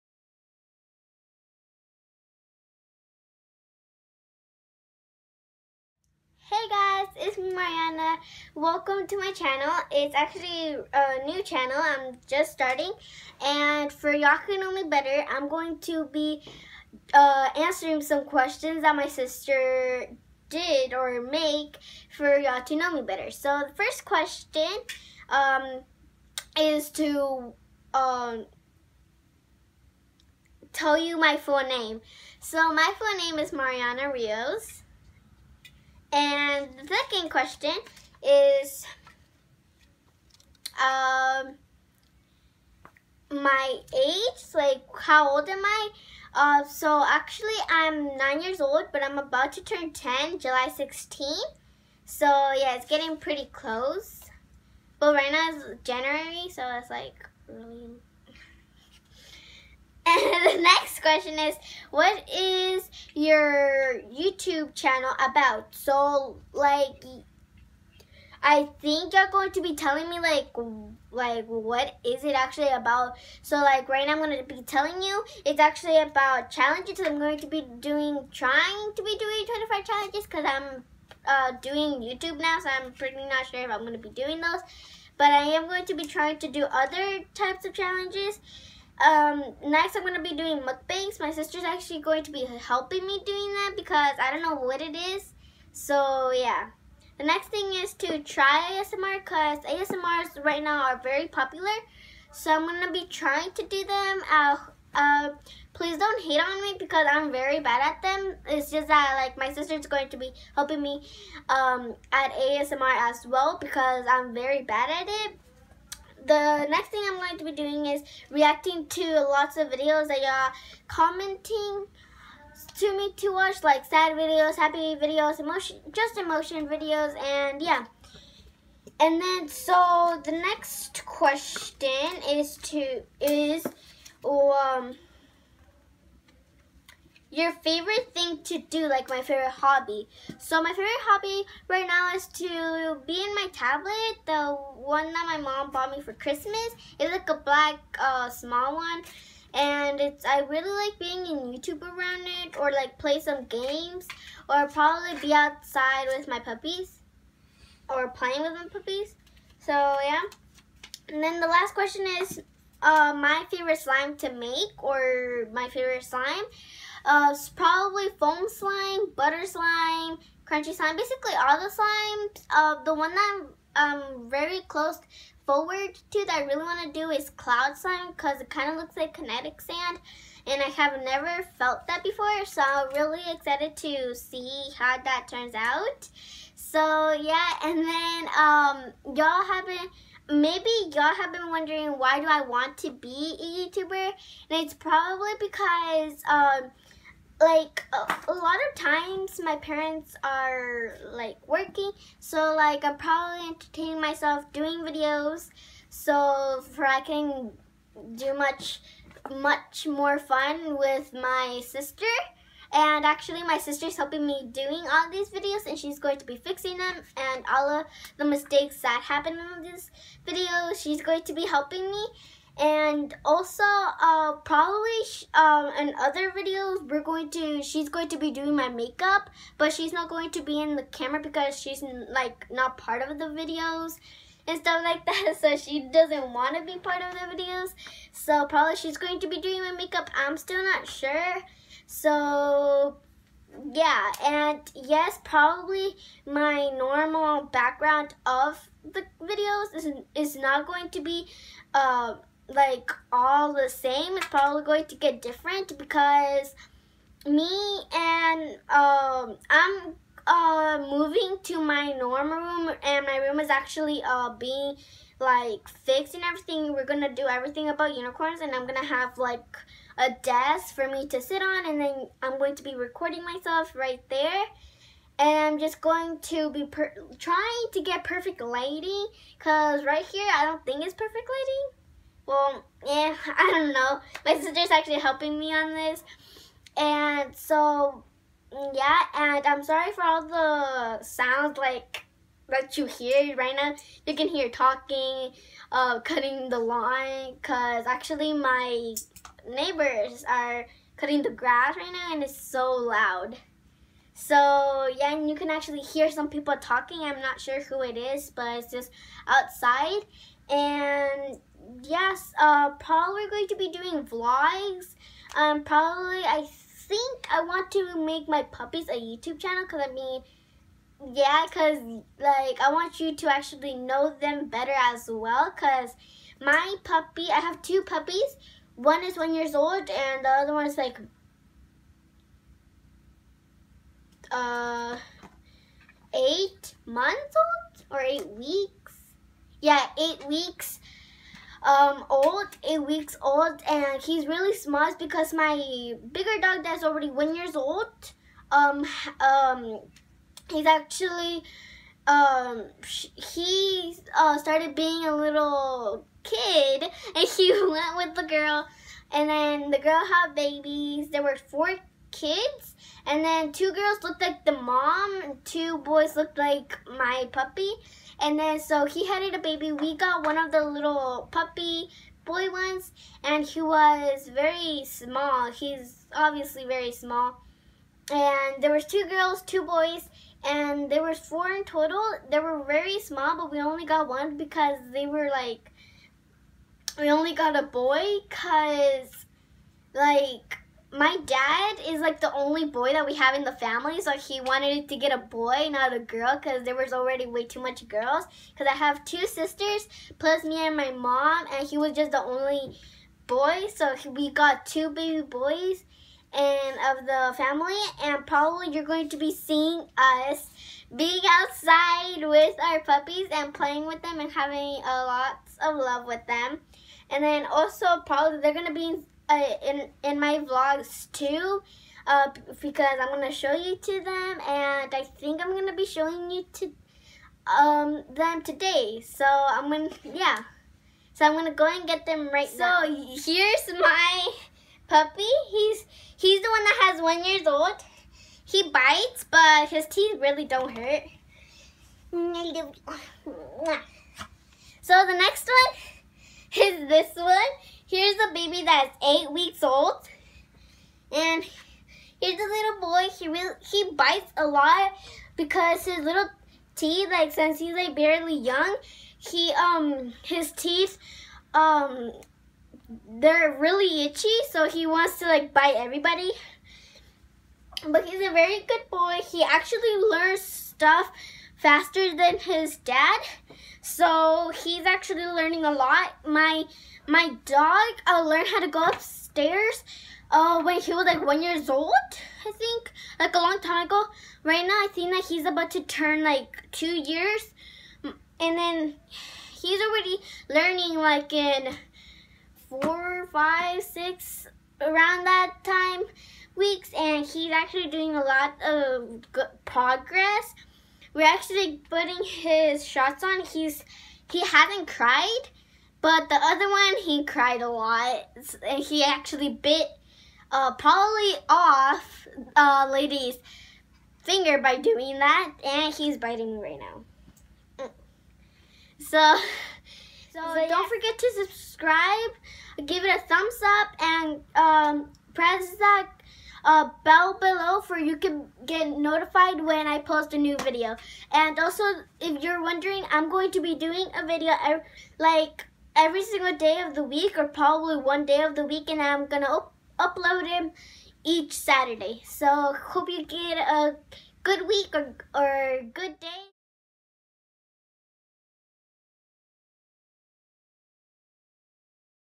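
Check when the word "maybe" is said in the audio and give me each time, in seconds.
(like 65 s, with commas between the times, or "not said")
190 s.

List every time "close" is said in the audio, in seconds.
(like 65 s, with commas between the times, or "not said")
53 s, 174 s.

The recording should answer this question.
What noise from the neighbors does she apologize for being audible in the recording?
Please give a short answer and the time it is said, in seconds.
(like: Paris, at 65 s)
Cutting the grass, at 300 s.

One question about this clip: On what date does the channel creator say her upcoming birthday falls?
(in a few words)
July 16.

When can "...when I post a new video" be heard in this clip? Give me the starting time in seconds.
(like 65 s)
529 s.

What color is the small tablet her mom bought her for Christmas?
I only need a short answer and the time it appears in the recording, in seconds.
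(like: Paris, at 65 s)
Black, at 147 s.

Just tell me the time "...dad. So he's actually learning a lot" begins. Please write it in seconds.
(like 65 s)
472 s.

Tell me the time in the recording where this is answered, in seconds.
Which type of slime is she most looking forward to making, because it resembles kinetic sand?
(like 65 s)
177 s.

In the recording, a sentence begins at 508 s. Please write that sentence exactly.
He actually bit uh, Polly off uh, Lady's finger by doing that, and he's biting right now.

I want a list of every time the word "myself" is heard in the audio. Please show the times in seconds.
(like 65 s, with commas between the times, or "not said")
203 s, 273 s.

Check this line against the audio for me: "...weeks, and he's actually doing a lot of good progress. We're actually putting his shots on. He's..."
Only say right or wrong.
right.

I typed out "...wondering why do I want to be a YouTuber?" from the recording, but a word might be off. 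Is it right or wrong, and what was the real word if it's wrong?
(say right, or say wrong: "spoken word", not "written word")
right.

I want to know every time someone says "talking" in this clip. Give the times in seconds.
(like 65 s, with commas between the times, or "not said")
294 s, 306 s.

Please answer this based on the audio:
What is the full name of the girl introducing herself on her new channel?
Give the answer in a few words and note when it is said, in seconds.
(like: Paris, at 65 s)
Mariana Rios, at 33 s.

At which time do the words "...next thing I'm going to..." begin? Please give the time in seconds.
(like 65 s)
116 s.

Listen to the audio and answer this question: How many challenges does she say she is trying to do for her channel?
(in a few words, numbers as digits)
25.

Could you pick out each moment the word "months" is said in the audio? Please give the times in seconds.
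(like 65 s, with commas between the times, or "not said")
336 s.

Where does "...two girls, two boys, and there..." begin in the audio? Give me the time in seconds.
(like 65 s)
378 s.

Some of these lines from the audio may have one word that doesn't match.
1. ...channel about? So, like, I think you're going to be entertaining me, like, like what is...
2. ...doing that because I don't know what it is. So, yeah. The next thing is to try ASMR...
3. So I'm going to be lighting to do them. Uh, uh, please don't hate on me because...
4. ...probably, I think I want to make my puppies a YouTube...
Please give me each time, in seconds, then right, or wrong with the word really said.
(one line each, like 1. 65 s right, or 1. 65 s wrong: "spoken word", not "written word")
1. 64 s wrong: "telling", not "entertaining"
2. 93 s right
3. 102 s wrong: "trying", not "lighting"
4. 315 s right.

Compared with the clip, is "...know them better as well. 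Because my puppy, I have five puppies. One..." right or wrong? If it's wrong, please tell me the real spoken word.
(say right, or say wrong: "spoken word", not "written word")
wrong: "two", not "five".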